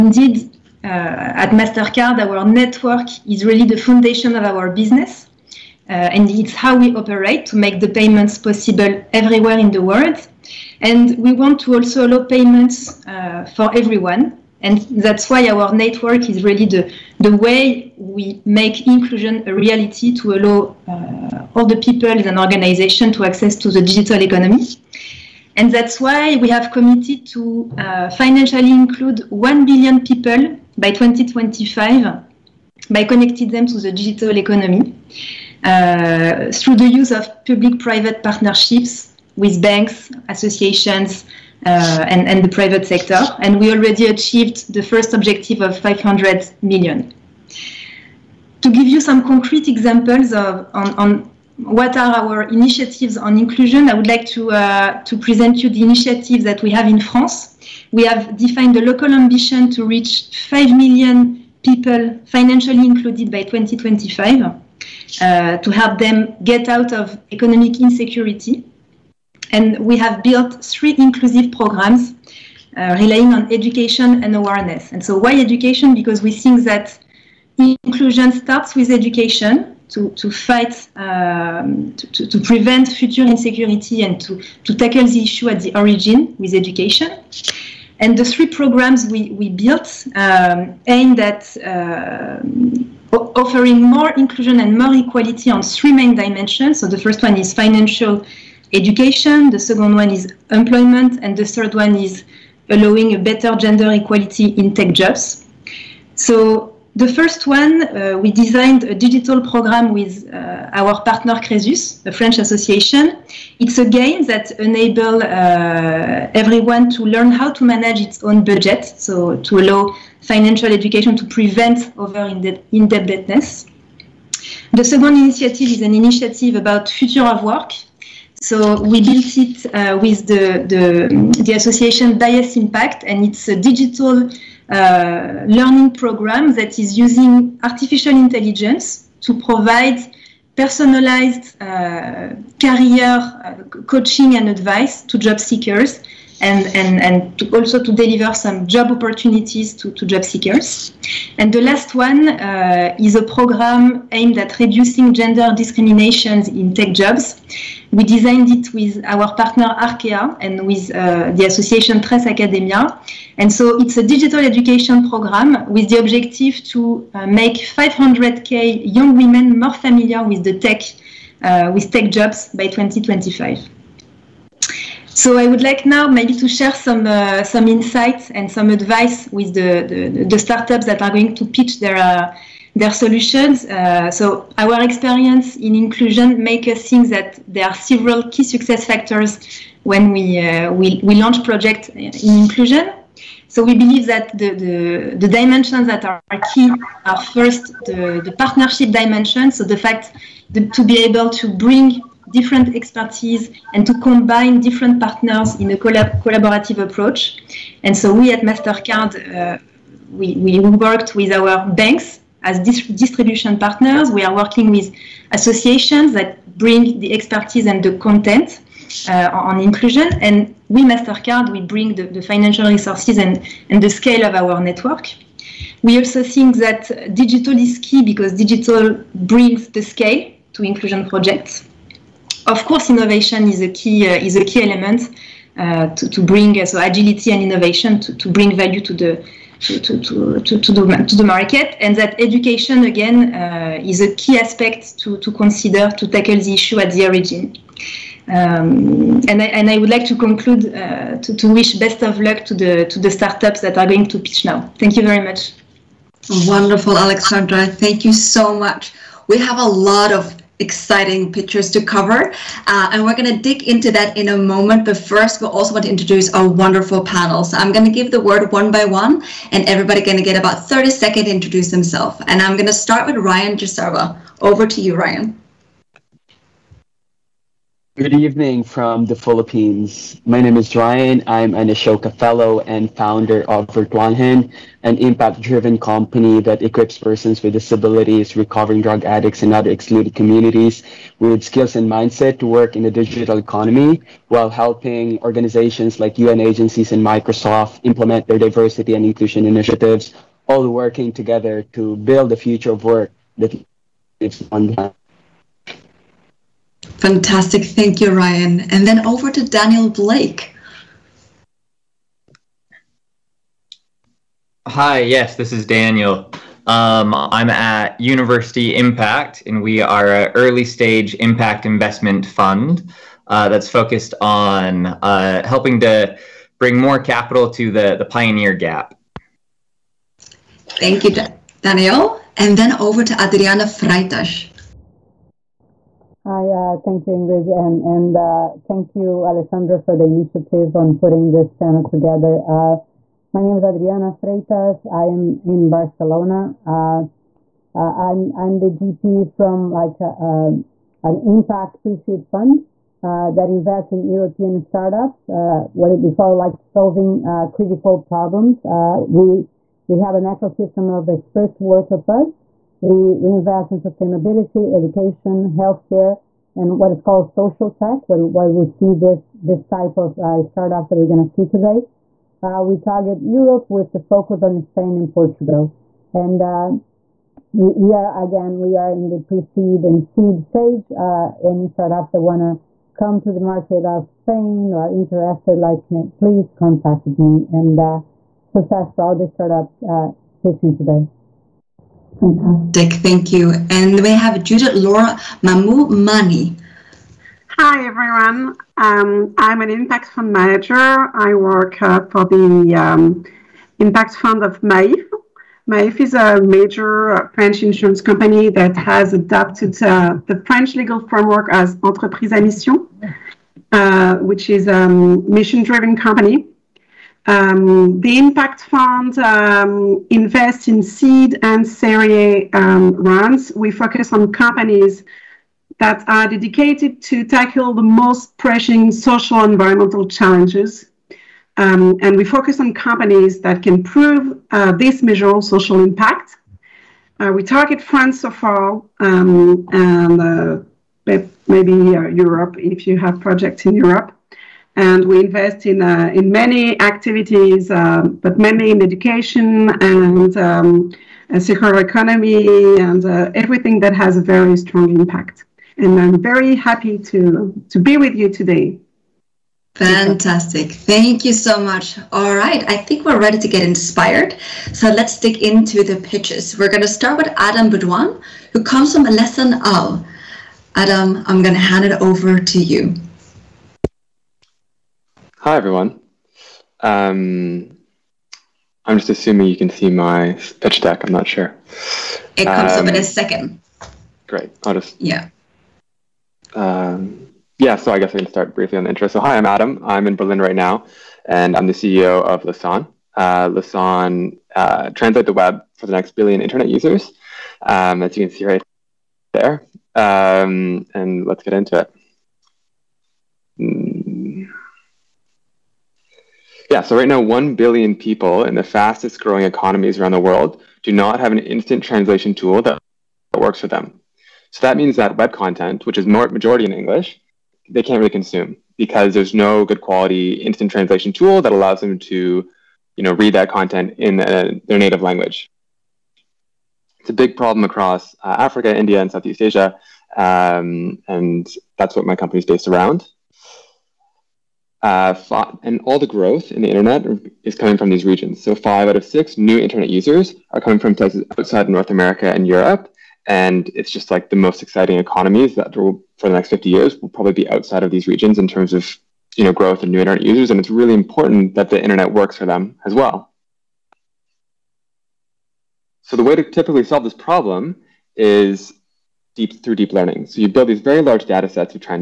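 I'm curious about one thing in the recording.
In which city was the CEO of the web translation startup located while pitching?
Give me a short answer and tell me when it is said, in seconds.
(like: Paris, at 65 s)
Berlin, at 490 s.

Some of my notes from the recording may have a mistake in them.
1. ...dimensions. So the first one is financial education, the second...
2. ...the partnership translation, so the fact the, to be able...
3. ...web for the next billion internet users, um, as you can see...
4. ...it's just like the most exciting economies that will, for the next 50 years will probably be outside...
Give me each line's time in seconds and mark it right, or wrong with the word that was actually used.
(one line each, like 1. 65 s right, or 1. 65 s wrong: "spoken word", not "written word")
1. 96 s right
2. 198 s wrong: "dimension", not "translation"
3. 495 s right
4. 543 s right.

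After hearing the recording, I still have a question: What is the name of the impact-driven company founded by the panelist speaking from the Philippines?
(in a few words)
Virtualahan.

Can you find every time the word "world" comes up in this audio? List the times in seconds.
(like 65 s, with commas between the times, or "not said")
9 s, 510 s.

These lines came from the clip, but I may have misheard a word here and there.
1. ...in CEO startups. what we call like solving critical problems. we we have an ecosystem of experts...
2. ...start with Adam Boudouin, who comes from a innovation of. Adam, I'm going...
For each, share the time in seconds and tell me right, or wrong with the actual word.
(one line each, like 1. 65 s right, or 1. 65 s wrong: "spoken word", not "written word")
1. 353 s wrong: "European", not "CEO"
2. 466 s wrong: "lesson", not "innovation".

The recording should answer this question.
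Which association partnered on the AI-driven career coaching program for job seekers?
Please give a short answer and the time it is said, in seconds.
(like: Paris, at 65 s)
Bias Impact, at 132 s.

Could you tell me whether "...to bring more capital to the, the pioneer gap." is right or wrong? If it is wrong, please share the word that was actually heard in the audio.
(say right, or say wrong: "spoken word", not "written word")
right.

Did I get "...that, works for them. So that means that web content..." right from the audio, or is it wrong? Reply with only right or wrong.
right.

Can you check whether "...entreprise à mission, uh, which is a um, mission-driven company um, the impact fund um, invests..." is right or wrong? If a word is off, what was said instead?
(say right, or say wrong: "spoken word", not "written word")
right.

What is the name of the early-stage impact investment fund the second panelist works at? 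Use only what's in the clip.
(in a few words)
University Impact.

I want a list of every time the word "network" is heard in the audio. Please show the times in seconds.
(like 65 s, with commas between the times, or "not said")
2 s, 15 s, 224 s.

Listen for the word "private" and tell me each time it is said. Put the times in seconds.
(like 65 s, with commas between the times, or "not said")
37 s, 42 s.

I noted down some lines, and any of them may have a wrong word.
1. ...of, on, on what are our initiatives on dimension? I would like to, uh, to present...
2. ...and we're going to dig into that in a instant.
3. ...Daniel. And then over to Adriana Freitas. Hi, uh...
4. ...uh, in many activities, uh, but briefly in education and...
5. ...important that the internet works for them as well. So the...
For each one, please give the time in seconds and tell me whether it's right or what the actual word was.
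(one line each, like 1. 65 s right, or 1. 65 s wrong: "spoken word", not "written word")
1. 50 s wrong: "inclusion", not "dimension"
2. 262 s wrong: "moment", not "instant"
3. 331 s right
4. 445 s wrong: "mainly", not "briefly"
5. 550 s right.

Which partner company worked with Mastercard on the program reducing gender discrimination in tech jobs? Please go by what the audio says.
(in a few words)
Arkea.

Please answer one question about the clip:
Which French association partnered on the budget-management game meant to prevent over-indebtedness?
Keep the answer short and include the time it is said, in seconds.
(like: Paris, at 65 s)
Cresus, at 111 s.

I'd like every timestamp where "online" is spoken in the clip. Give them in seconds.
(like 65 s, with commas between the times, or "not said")
304 s.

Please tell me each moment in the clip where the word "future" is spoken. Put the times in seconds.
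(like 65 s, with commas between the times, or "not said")
82 s, 126 s, 302 s.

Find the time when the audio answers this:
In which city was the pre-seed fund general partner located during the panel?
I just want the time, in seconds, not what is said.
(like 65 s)
345 s.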